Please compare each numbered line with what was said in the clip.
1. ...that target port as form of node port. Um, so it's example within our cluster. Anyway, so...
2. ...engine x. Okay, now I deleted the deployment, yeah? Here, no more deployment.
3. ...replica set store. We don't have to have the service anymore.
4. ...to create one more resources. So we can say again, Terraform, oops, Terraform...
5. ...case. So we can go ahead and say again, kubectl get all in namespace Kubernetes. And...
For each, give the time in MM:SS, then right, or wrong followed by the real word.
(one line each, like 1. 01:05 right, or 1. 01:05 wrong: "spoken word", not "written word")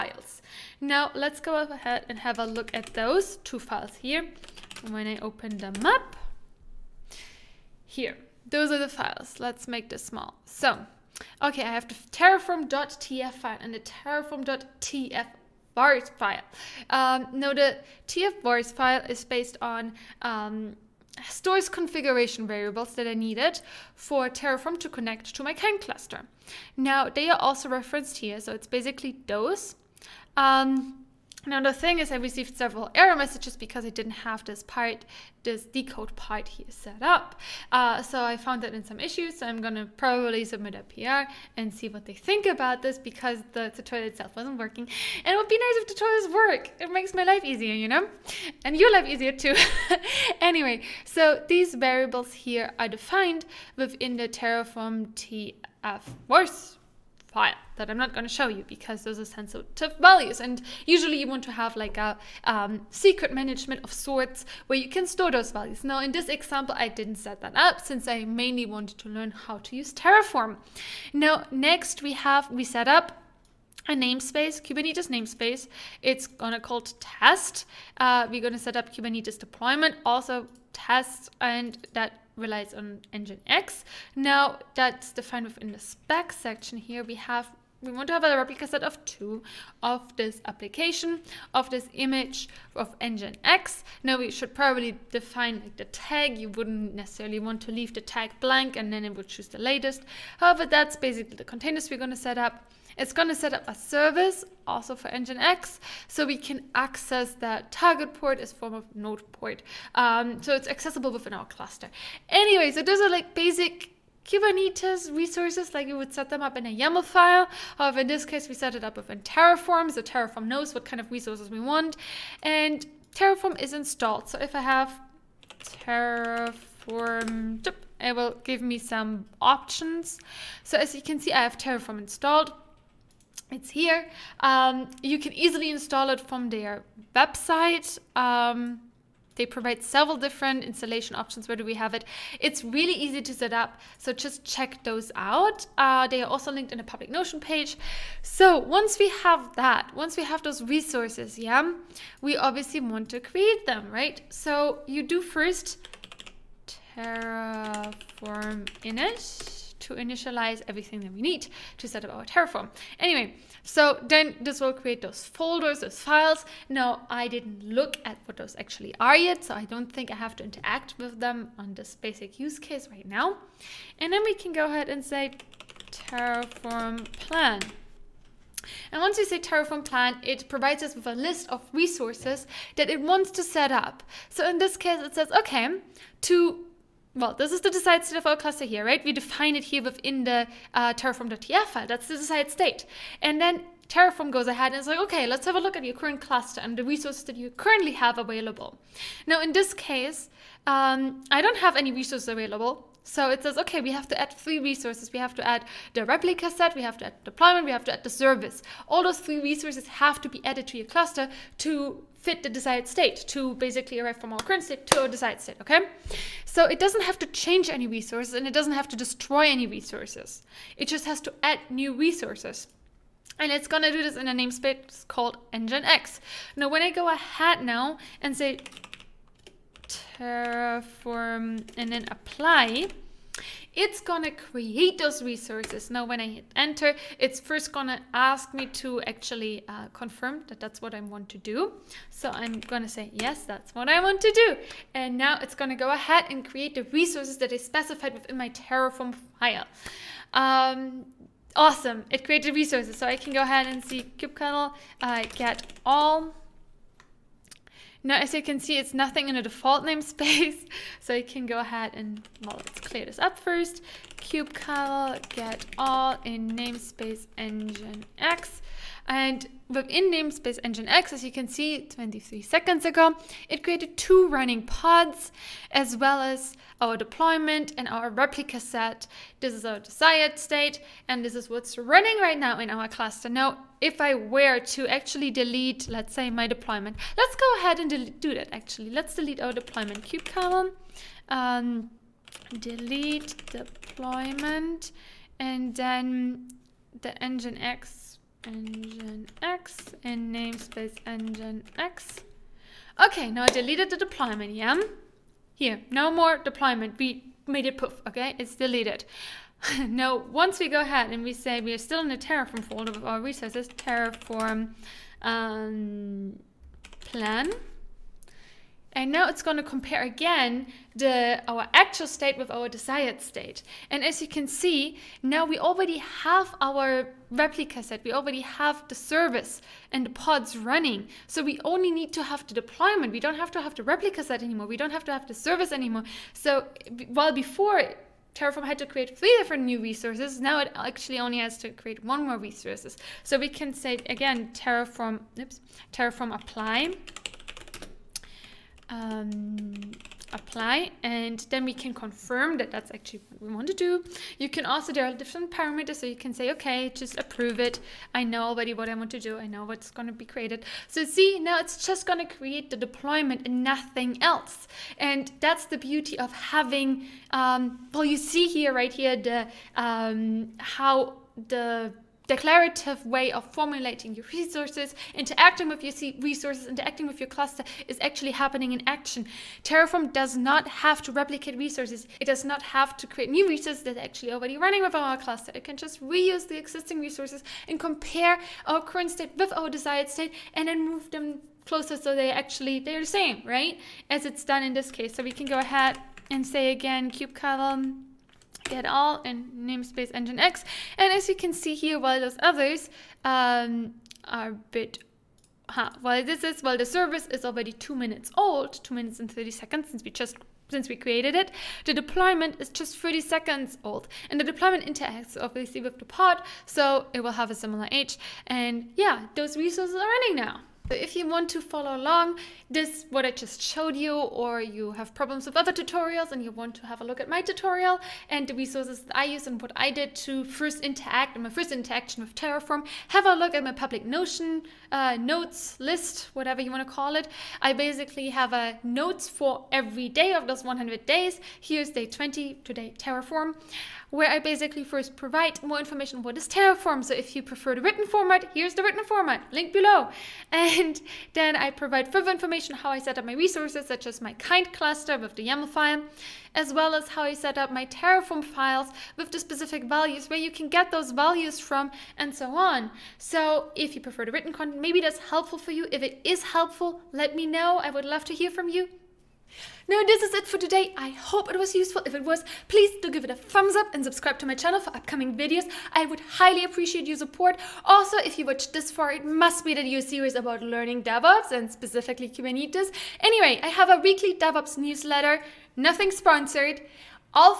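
1. 01:47 wrong: "accessible", not "example"
2. 05:01 right
3. 05:33 wrong: "anymore", not "store"
4. 05:41 right
5. 06:34 wrong: "Nginx", not "Kubernetes".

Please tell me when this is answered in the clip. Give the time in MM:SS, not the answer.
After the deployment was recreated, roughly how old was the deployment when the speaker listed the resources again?
06:52.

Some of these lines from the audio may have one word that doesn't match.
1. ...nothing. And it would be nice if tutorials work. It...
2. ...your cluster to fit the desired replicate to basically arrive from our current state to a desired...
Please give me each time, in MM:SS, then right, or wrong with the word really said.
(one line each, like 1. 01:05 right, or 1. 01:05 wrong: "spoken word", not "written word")
1. 00:44 wrong: "working", not "nothing"
2. 03:30 wrong: "state", not "replicate".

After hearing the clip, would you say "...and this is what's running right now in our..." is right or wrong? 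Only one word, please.
right.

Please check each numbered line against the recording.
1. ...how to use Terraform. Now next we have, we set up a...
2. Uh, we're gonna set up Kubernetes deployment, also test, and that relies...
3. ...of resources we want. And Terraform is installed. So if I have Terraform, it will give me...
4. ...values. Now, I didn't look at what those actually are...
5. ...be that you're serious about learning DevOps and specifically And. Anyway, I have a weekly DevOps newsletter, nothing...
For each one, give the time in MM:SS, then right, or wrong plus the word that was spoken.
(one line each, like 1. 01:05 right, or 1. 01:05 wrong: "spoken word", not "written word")
1. 01:09 right
2. 01:17 right
3. 02:00 right
4. 02:45 wrong: "files", not "values"
5. 07:59 wrong: "Kubernetes", not "And".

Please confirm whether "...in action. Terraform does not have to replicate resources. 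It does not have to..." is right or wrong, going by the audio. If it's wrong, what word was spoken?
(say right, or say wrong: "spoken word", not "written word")
right.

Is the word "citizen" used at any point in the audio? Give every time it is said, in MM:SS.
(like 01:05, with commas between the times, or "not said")
not said.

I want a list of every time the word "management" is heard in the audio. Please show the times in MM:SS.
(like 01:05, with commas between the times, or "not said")
01:03.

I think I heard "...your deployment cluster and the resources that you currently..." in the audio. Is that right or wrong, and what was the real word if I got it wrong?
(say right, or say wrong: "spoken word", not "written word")
wrong: "current", not "deployment".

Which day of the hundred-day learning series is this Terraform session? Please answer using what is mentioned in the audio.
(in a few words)
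day 20.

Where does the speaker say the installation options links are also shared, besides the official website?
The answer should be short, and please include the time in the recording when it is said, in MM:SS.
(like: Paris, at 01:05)
a public Notion page, at 02:26.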